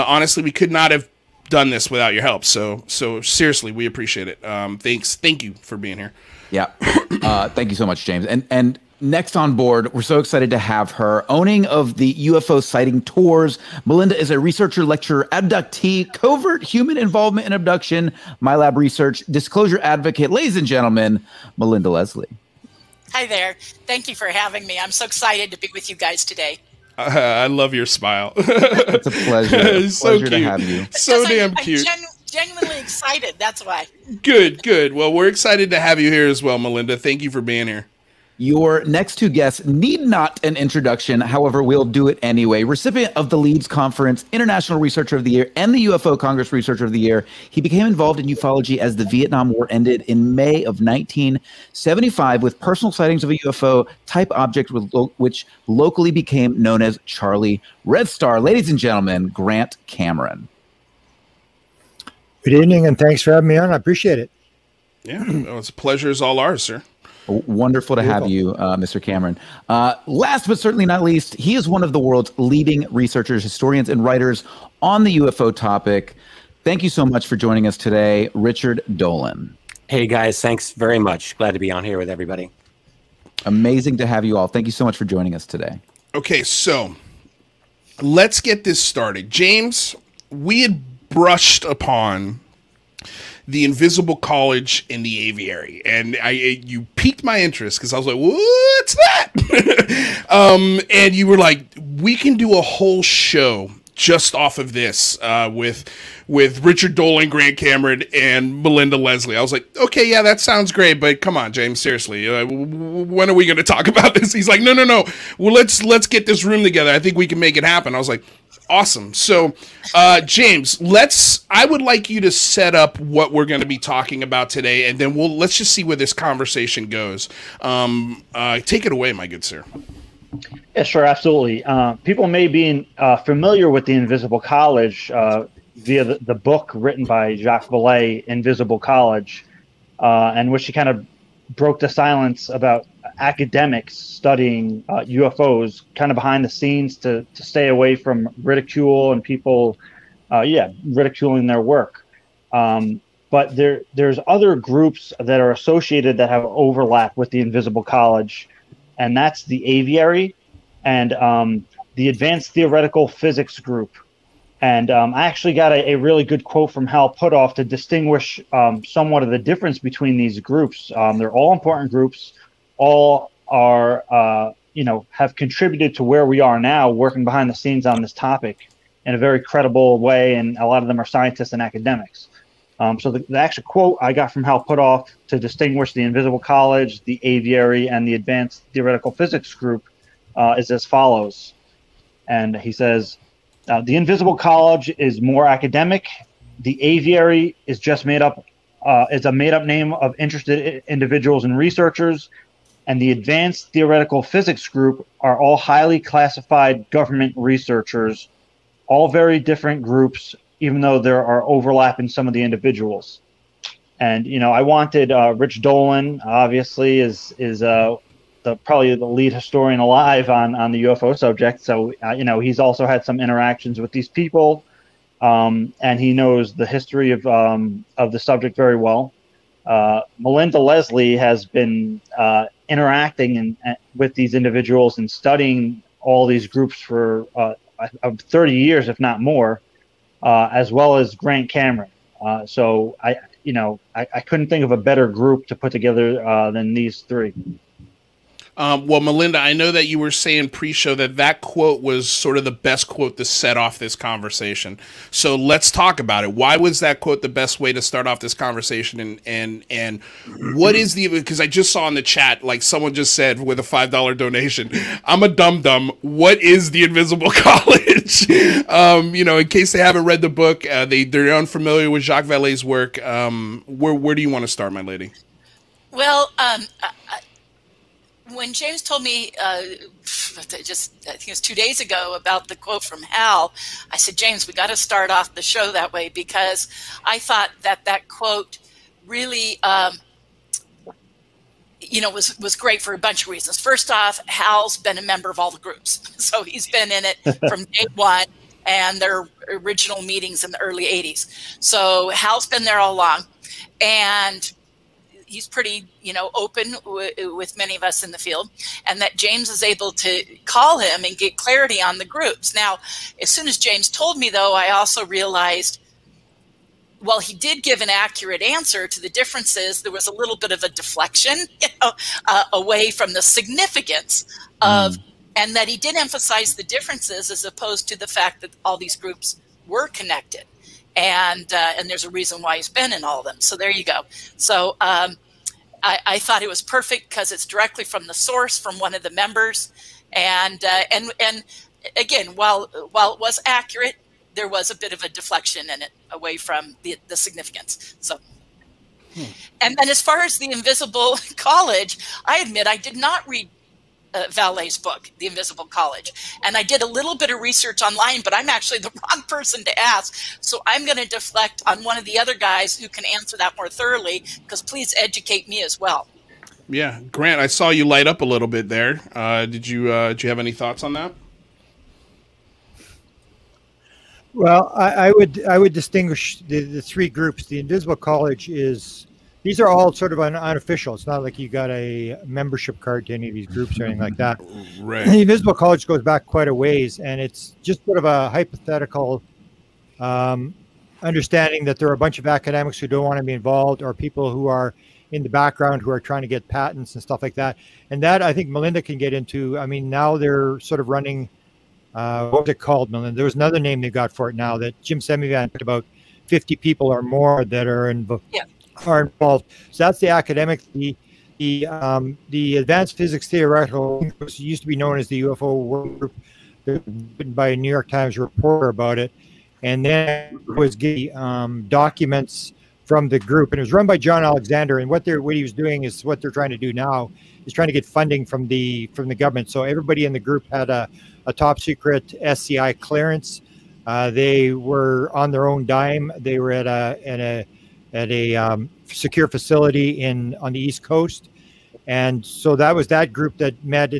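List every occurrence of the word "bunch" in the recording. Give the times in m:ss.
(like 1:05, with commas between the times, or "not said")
4:52, 6:31.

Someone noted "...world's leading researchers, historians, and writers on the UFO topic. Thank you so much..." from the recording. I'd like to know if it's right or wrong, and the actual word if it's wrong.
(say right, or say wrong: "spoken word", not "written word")
right.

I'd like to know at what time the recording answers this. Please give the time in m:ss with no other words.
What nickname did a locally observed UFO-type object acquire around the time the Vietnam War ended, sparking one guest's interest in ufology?
0:57.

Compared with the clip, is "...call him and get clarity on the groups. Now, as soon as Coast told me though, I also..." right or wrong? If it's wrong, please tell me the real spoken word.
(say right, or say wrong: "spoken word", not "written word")
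wrong: "James", not "Coast".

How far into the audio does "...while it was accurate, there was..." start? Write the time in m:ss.
5:42.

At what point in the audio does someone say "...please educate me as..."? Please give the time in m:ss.
6:04.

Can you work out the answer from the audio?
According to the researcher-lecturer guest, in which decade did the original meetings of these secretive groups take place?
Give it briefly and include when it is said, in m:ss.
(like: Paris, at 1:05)
1980s, at 5:00.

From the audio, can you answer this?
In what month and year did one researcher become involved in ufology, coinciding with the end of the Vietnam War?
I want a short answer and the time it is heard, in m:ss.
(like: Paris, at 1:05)
May 1975, at 0:50.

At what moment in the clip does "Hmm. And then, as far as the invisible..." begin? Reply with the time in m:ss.
5:49.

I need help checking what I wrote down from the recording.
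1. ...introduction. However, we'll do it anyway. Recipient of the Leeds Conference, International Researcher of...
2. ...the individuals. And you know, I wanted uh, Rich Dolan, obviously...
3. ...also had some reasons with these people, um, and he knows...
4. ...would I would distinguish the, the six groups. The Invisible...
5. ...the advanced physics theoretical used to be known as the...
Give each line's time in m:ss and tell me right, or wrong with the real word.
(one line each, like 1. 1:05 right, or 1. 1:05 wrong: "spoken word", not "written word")
1. 0:40 right
2. 3:32 right
3. 3:42 wrong: "interactions", not "reasons"
4. 6:15 wrong: "three", not "six"
5. 6:52 right.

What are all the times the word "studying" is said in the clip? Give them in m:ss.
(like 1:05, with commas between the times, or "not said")
2:23, 3:55.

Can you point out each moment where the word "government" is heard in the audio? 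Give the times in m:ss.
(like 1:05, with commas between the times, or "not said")
3:26, 7:09.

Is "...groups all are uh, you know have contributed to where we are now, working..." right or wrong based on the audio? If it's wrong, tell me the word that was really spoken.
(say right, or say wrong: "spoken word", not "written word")
right.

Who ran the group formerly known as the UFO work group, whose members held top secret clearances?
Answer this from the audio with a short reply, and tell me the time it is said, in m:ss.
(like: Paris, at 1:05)
John Alexander, at 7:03.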